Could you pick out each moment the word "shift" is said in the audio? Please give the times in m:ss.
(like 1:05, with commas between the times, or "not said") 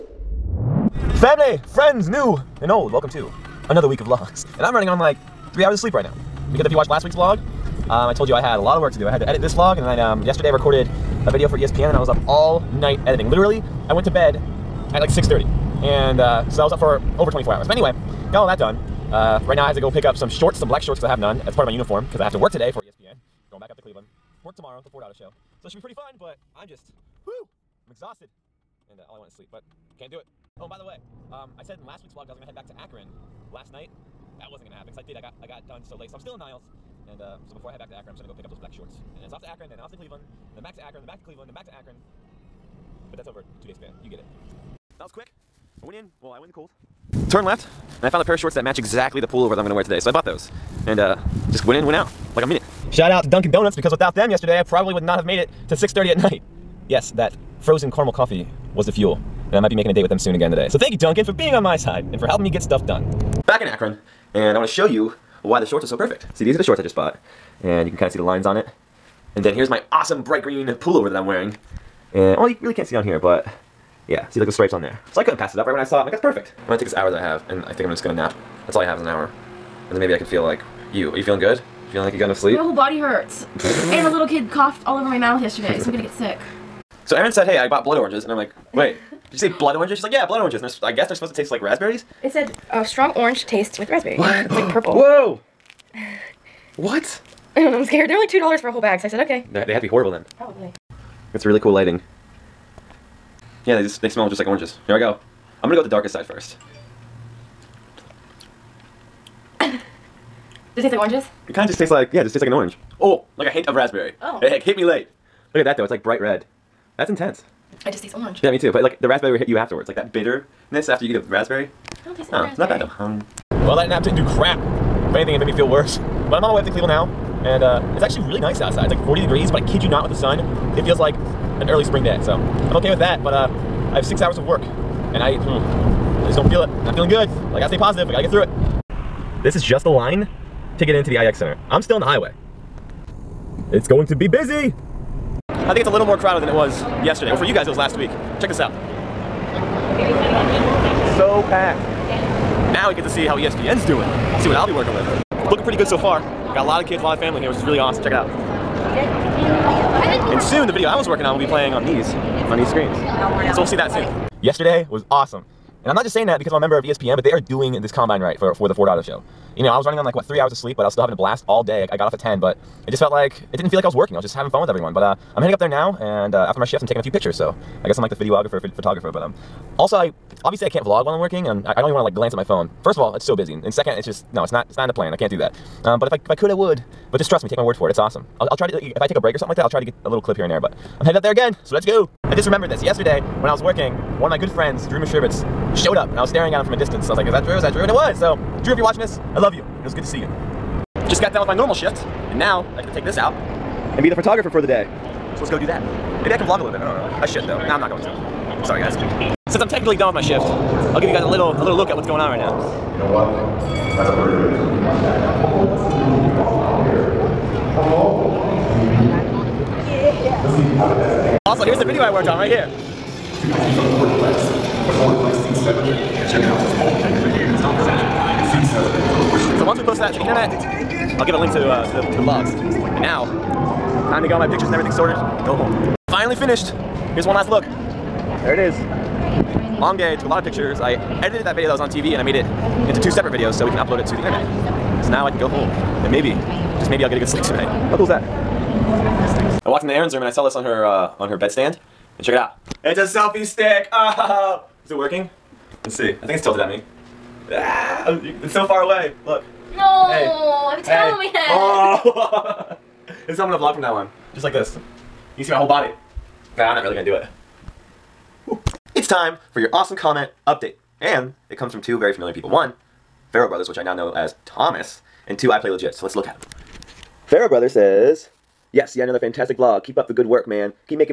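2:56, 3:21, 3:30.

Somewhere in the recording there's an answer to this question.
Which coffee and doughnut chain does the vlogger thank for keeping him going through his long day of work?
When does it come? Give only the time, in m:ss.
0:53.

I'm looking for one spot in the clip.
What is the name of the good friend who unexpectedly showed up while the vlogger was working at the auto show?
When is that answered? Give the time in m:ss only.
3:14.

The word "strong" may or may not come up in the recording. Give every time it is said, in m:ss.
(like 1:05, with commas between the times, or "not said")
1:32.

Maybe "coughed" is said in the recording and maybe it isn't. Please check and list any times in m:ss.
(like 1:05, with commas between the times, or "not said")
1:24.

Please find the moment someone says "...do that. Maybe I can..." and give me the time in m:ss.
3:25.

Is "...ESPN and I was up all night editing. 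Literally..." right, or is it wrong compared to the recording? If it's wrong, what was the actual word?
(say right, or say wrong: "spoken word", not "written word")
right.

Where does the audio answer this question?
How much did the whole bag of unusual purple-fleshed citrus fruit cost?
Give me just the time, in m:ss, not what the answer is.
1:38.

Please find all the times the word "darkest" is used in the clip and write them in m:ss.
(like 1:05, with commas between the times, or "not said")
1:45.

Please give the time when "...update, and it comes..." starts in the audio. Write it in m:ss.
4:30.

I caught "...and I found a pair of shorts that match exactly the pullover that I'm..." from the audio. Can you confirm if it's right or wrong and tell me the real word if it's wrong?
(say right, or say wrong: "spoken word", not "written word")
right.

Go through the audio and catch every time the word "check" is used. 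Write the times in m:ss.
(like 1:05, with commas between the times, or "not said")
2:28, 2:38, 3:46, 4:12.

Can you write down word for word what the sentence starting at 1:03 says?
Back in Akron, and I want to show you why the shorts are so perfect.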